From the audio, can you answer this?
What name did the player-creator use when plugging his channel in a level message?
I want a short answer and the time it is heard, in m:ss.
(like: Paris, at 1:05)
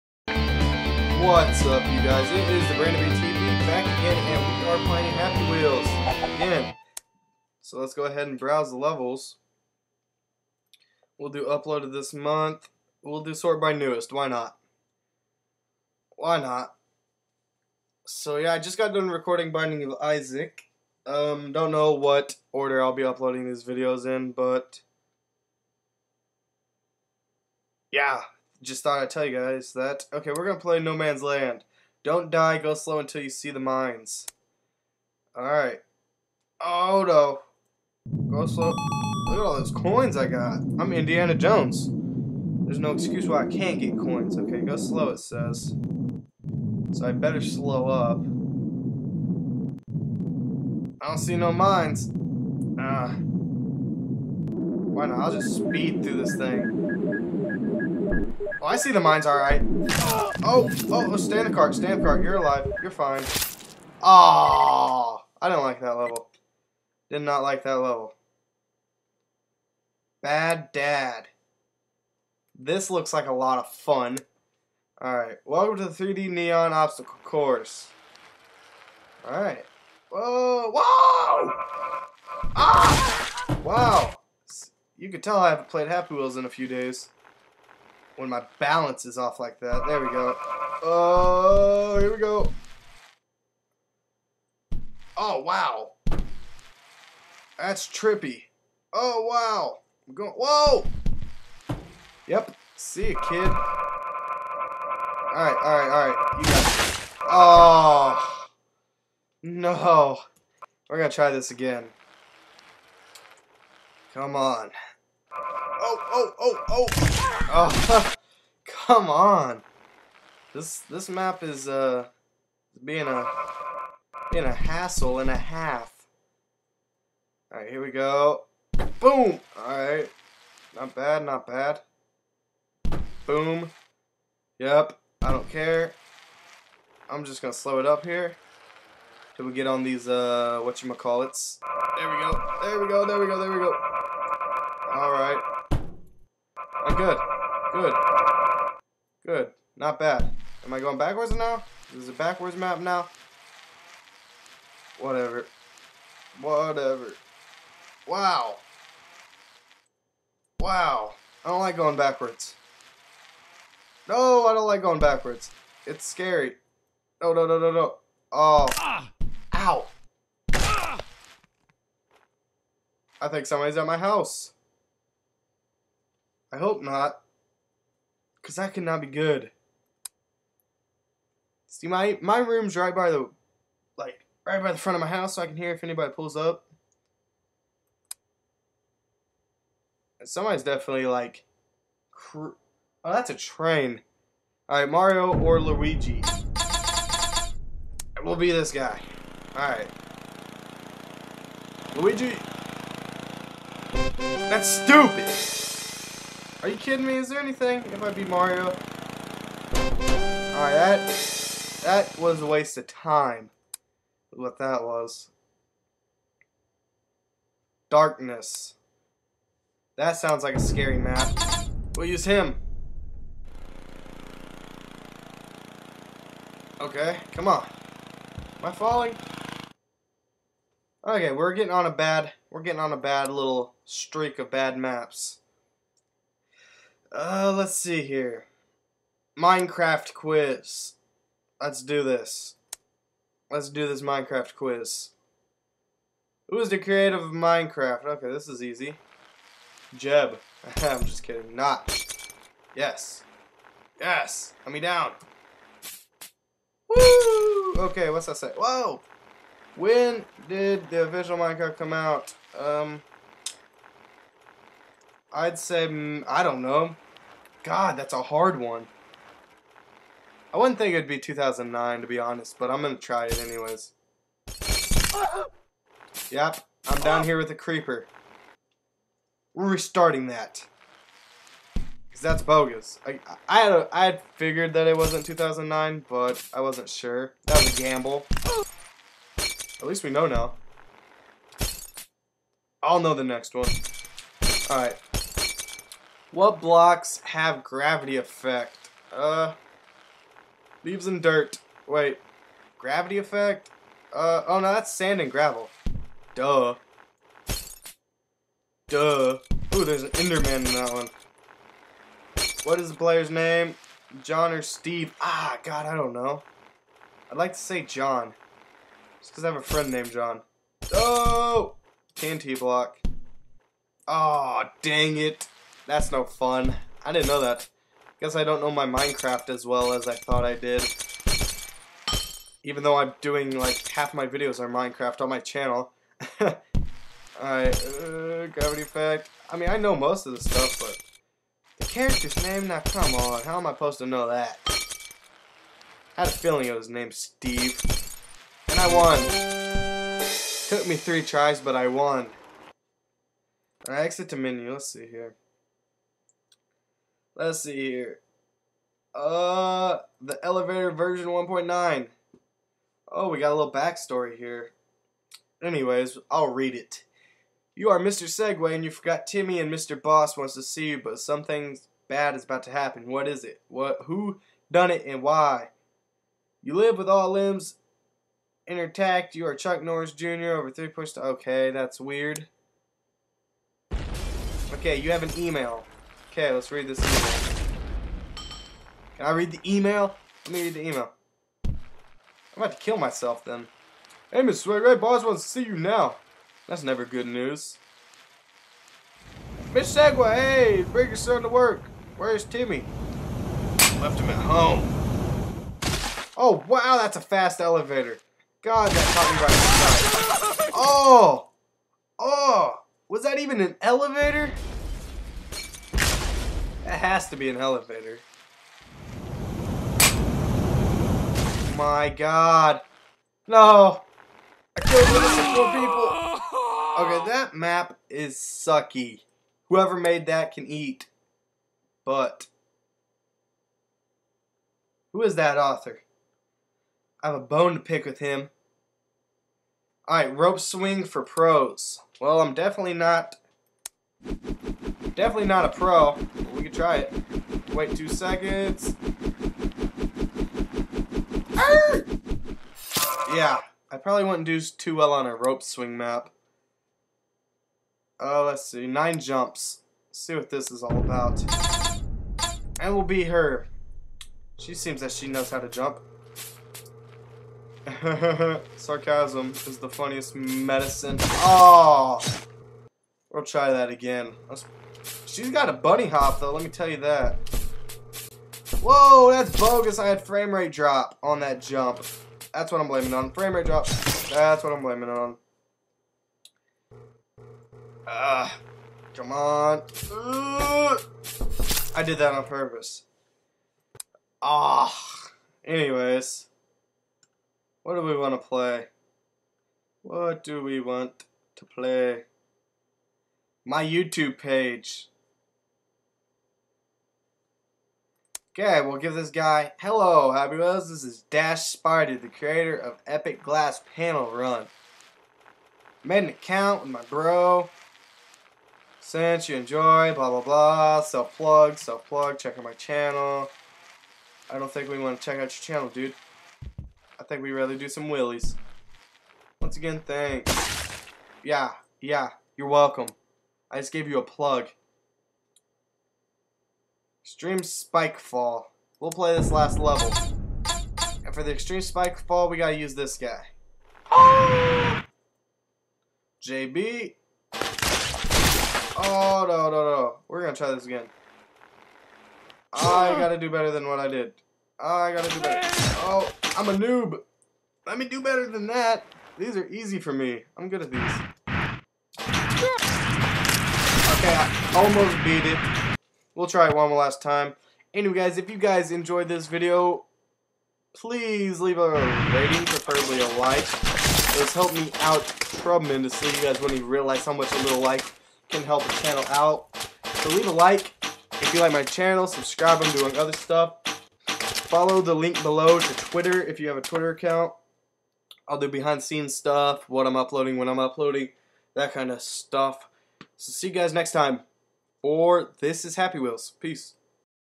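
Dash Spidey, at 8:31.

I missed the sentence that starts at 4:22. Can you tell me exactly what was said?
Um, I'd say, mm, I don't know.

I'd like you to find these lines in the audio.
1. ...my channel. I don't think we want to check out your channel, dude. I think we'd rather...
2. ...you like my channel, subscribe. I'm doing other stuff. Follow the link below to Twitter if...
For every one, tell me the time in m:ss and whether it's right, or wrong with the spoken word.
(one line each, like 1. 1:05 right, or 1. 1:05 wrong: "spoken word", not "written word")
1. 8:42 right
2. 9:41 right.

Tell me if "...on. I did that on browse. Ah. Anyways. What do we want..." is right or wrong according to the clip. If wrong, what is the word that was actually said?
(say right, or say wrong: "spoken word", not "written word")
wrong: "purpose", not "browse".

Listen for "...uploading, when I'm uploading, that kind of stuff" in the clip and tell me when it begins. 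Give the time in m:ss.
9:50.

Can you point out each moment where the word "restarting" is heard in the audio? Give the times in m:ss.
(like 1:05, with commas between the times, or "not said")
4:39.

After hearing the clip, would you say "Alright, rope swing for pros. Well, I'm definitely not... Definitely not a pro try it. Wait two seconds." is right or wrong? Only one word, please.
right.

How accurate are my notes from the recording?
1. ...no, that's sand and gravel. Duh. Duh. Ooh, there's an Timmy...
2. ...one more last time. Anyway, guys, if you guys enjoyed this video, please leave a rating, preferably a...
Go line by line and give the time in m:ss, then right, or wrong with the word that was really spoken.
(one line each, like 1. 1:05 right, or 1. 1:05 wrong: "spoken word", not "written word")
1. 5:04 wrong: "Enderman", not "Timmy"
2. 9:26 right.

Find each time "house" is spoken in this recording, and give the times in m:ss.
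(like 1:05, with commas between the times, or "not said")
2:53, 3:05.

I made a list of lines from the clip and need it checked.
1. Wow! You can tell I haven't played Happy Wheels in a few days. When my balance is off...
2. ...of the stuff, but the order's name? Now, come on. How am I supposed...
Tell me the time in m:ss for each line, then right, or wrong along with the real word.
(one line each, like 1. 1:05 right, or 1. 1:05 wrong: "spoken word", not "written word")
1. 1:23 right
2. 5:40 wrong: "character", not "order".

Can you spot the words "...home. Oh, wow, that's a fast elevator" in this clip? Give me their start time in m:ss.
6:44.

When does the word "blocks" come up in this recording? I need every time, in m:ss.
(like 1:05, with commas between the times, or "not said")
4:56, 5:22.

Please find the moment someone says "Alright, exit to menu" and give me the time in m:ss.
5:53.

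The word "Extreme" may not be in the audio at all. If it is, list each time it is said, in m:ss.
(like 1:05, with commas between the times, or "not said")
8:57, 9:01.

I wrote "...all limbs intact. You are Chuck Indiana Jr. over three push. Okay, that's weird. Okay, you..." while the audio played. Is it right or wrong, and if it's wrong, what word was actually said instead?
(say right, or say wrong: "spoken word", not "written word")
wrong: "Norris", not "Indiana".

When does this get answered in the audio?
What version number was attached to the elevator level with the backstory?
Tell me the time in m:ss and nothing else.
6:01.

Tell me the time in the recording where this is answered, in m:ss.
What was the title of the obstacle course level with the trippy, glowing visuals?
1:15.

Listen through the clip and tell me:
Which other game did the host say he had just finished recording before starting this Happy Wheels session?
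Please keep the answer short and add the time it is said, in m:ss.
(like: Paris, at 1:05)
Binding of Isaac, at 0:19.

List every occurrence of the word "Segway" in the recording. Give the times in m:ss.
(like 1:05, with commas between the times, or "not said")
6:08, 6:39.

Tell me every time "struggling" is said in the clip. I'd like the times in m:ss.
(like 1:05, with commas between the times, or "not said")
not said.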